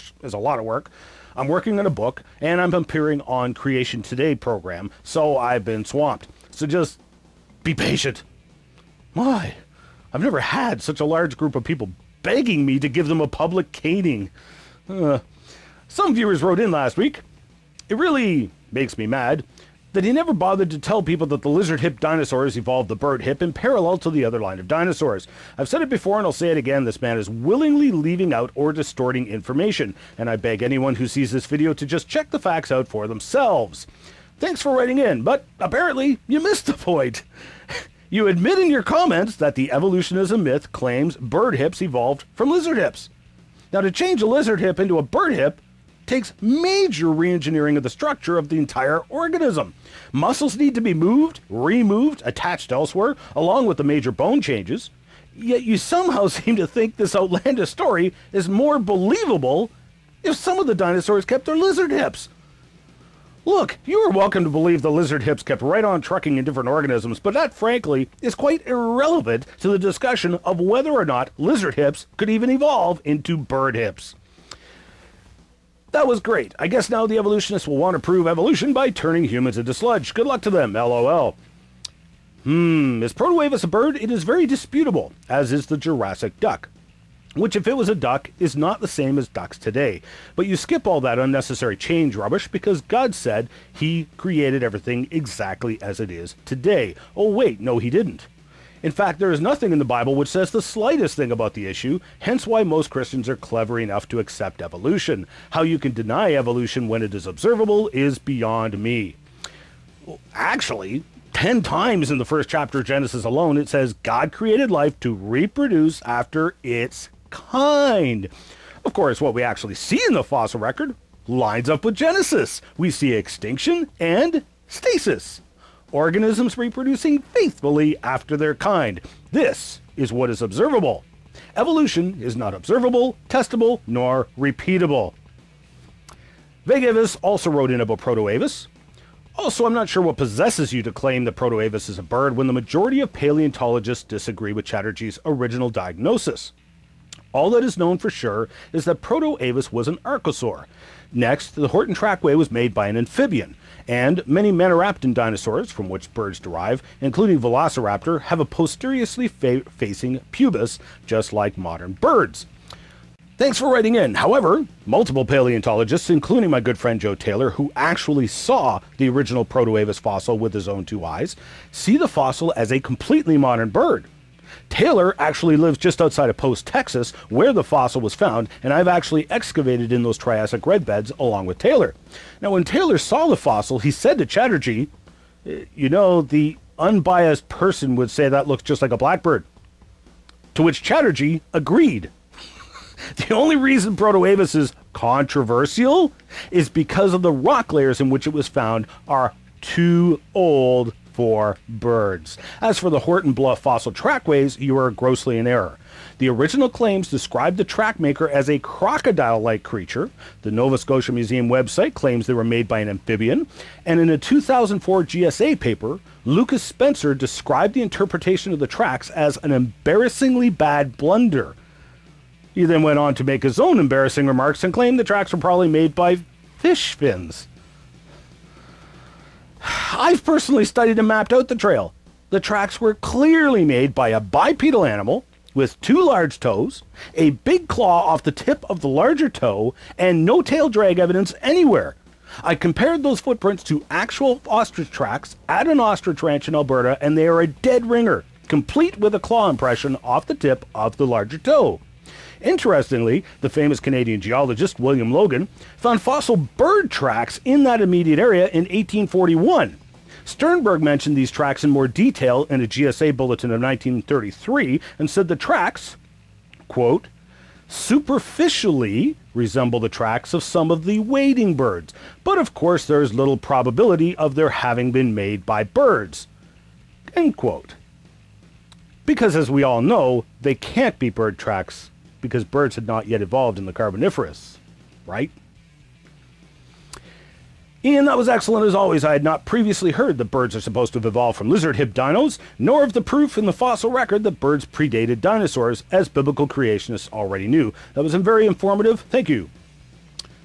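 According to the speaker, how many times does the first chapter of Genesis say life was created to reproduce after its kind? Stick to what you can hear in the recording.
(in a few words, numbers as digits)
10.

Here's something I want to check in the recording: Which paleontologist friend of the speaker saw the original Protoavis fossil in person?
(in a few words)
Joe Taylor.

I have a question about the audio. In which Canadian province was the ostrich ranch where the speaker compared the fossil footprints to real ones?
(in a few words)
Alberta.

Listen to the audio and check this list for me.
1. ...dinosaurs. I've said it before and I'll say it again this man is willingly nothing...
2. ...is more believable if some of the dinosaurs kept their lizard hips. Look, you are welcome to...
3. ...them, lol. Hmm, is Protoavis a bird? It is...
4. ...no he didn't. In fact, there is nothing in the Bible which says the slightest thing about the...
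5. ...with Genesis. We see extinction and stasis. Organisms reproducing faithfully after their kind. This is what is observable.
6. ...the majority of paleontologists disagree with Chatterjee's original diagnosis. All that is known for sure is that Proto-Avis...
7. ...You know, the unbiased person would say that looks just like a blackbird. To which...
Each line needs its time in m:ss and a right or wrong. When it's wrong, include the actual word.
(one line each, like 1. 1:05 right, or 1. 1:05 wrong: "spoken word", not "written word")
1. 0:24 wrong: "leaving", not "nothing"
2. 0:58 right
3. 1:20 right
4. 1:37 right
5. 2:01 right
6. 2:22 right
7. 3:05 right.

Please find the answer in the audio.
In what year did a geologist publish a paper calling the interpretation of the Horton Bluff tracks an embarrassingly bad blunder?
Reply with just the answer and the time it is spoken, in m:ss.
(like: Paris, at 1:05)
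2004, at 3:34.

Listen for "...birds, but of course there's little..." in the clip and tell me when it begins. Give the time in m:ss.
4:31.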